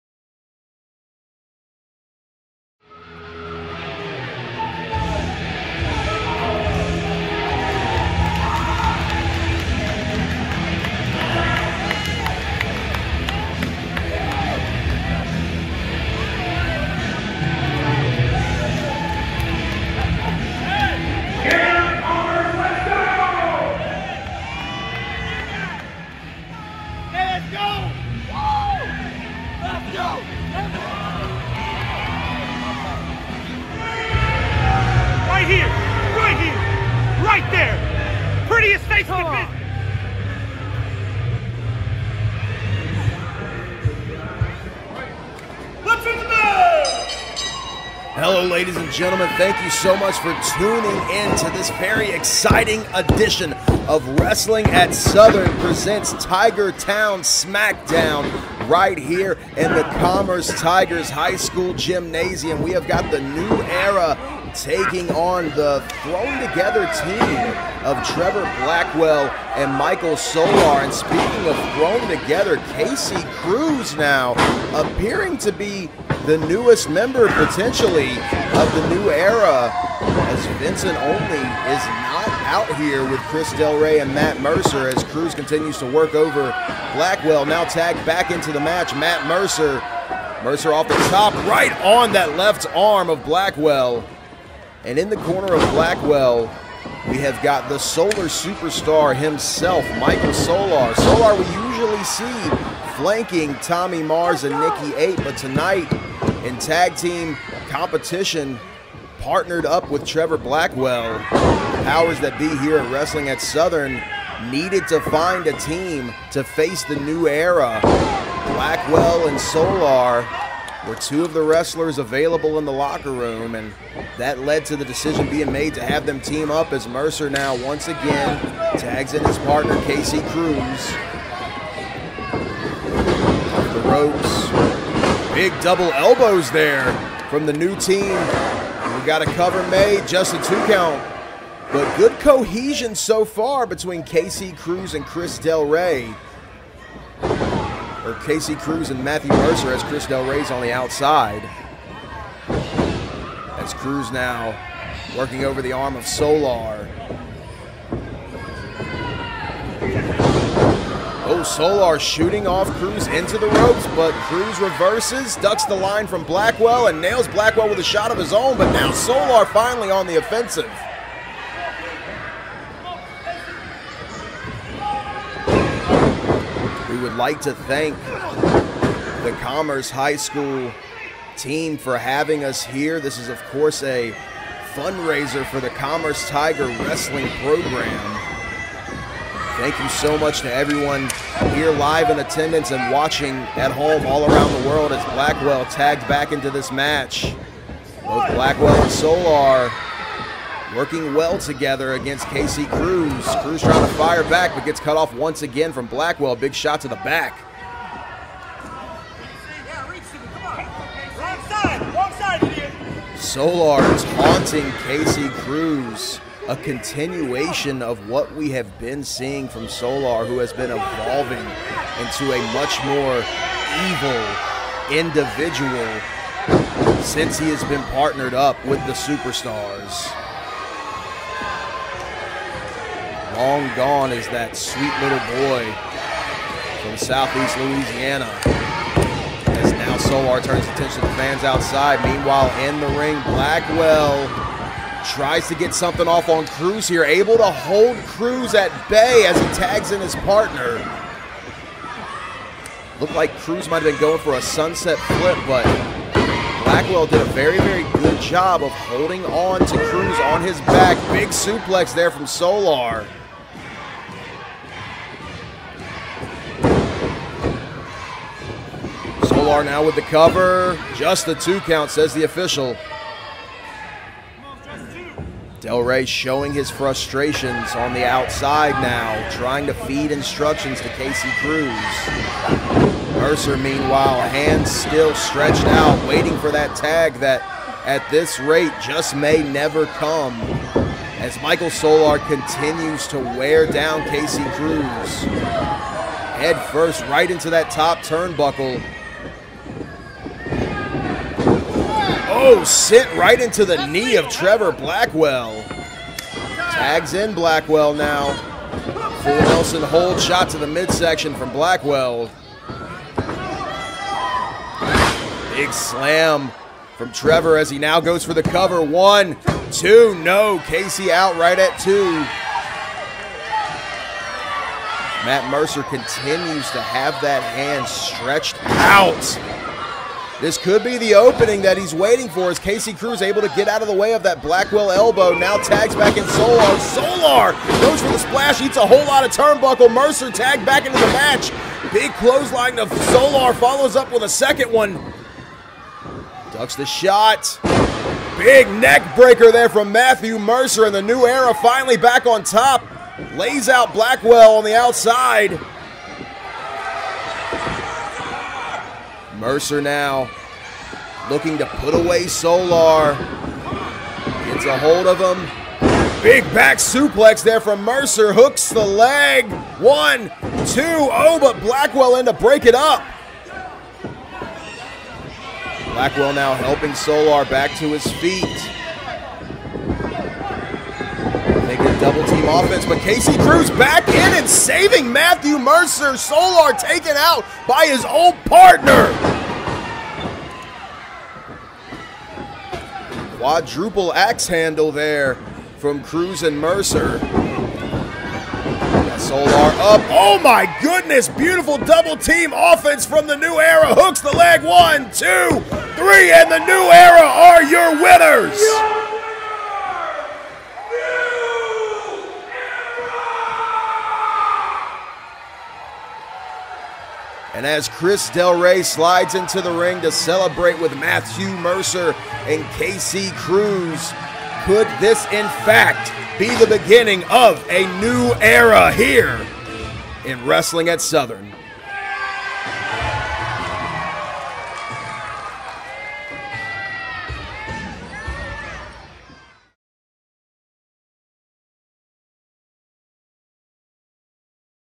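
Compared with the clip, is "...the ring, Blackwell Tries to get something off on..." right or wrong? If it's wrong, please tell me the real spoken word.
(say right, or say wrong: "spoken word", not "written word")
right.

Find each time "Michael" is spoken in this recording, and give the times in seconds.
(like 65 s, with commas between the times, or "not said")
69 s, 99 s, 291 s.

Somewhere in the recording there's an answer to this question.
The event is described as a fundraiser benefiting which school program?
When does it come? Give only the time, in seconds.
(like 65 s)
185 s.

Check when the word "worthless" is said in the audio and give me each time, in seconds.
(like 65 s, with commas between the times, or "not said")
not said.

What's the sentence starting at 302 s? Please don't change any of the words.
Oh, sit right into the knee of Trevor Blackwell.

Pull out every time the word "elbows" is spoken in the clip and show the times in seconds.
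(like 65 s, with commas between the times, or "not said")
135 s, 334 s.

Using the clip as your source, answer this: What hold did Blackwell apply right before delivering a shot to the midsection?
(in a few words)
Full Nelson.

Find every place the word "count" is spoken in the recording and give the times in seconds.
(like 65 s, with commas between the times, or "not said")
140 s, 271 s.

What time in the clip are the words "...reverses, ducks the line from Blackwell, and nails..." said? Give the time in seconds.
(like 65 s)
164 s.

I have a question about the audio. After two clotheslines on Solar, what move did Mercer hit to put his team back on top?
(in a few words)
Neck breaker.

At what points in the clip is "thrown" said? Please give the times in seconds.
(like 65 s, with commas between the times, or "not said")
66 s, 71 s.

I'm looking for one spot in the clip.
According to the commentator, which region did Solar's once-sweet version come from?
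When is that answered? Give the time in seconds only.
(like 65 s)
236 s.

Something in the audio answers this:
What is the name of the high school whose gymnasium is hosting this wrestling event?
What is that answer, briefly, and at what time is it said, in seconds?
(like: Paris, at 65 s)
Commerce Tigers High School, at 59 s.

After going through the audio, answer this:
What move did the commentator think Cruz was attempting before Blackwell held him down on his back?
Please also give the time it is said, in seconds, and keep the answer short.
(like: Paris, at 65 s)
Sunset flip, at 254 s.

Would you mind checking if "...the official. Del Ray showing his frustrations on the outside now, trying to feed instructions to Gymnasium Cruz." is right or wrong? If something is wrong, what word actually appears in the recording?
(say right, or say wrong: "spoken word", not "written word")
wrong: "Casey", not "Gymnasium".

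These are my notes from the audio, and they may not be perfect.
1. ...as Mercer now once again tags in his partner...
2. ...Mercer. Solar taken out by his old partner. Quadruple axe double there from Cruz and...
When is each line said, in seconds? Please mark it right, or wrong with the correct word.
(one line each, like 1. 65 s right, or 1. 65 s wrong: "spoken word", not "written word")
1. 126 s right
2. 385 s wrong: "handle", not "double".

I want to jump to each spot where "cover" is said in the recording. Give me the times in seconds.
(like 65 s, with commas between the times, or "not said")
139 s, 270 s, 318 s.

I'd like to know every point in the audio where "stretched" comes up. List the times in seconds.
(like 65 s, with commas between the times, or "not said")
285 s, 327 s.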